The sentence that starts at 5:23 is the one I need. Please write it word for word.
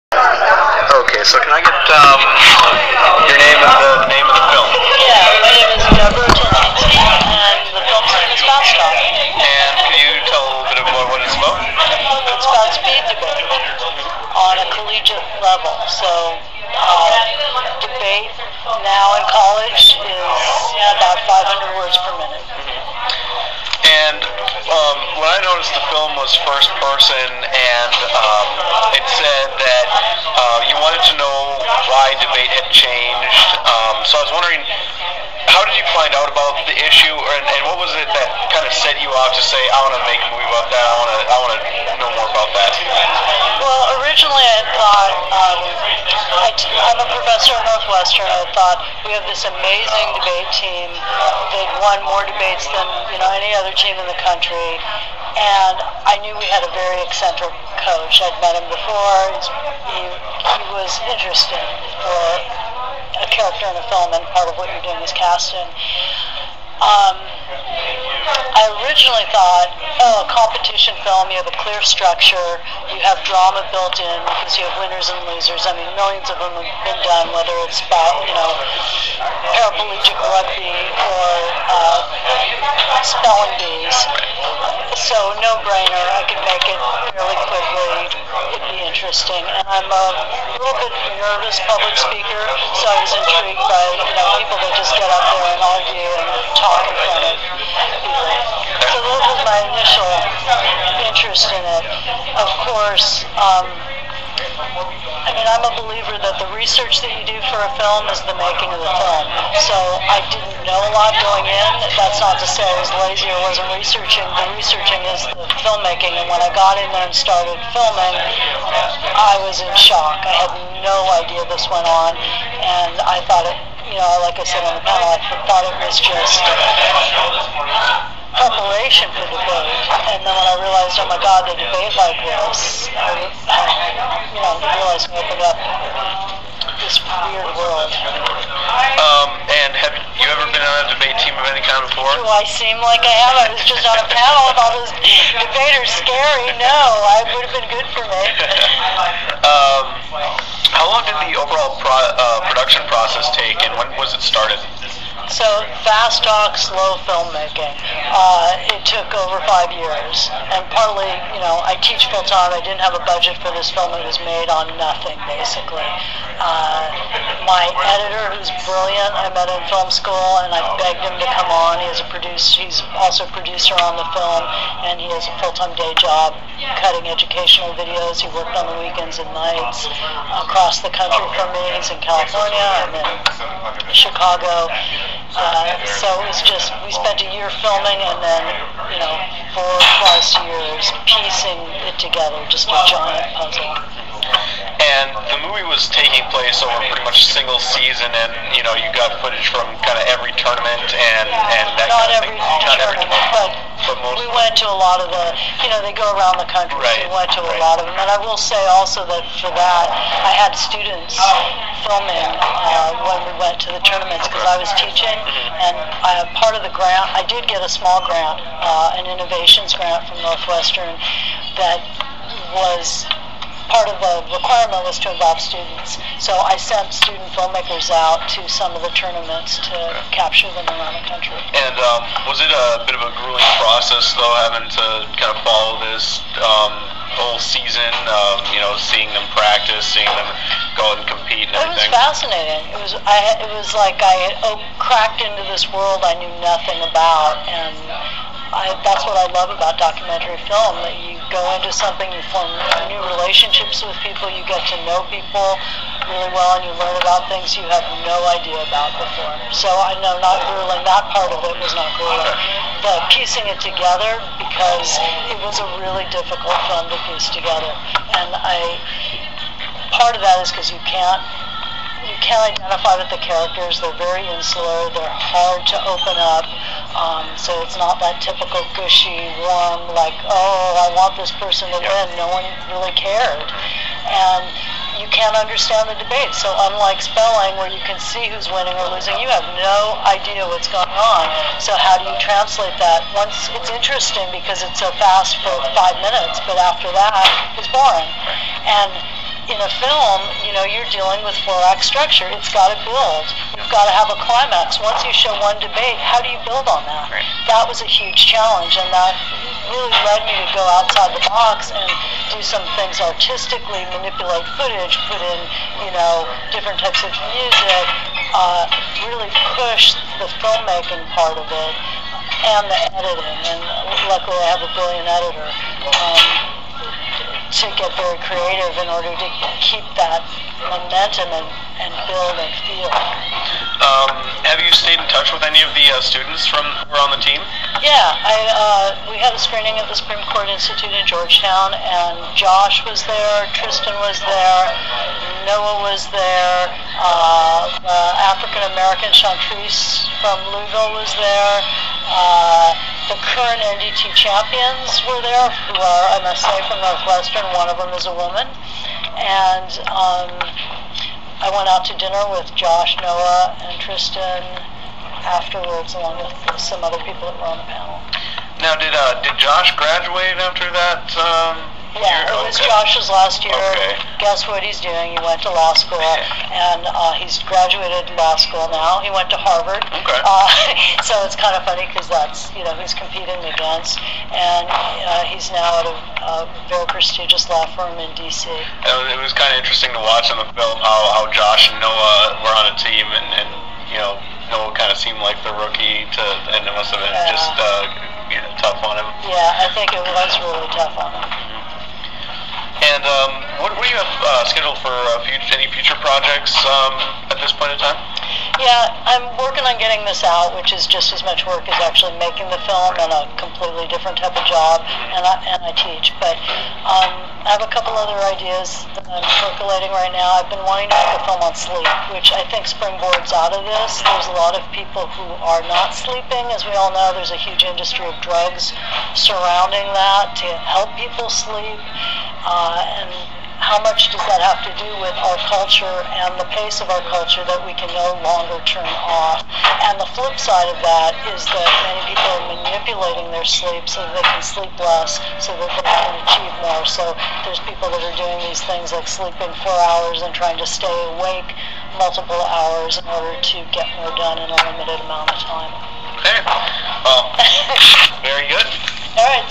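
And luckily, I have a brilliant editor.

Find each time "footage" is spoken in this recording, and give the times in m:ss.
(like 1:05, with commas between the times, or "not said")
3:19, 5:14.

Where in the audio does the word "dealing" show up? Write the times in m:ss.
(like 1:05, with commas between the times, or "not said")
5:00.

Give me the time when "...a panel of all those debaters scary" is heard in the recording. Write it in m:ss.
2:23.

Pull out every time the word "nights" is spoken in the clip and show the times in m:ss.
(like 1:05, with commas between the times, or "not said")
2:59.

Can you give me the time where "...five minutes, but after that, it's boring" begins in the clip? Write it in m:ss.
4:55.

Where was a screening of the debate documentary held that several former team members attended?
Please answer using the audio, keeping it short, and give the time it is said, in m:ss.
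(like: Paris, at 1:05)
Supreme Court Institute in Georgetown, at 5:39.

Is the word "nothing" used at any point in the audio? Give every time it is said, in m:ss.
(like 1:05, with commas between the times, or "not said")
2:44, 4:06.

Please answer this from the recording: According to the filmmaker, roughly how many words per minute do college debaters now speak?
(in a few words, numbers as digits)
500.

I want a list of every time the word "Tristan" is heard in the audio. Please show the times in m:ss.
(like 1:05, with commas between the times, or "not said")
5:43, 6:03.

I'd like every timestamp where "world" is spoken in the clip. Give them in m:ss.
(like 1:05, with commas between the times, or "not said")
2:17, 4:05.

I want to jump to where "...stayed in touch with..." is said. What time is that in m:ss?
5:34.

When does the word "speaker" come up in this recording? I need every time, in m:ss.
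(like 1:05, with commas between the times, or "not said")
1:31.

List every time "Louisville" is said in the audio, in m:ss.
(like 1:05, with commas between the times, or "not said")
5:50.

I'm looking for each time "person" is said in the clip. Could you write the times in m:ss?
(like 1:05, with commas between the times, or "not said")
0:26, 4:41.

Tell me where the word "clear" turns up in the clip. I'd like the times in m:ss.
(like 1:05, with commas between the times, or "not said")
1:11.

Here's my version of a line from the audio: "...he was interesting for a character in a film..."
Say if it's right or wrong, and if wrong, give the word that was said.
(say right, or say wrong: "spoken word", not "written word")
right.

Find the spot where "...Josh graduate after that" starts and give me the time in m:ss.
6:09.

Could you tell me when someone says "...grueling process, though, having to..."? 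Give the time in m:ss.
3:53.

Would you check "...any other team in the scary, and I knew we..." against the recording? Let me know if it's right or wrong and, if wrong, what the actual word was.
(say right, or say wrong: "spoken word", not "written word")
wrong: "country", not "scary".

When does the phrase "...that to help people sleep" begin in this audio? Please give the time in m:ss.
7:09.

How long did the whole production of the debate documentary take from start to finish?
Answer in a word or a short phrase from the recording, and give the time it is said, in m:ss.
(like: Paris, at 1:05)
over 5 years, at 2:39.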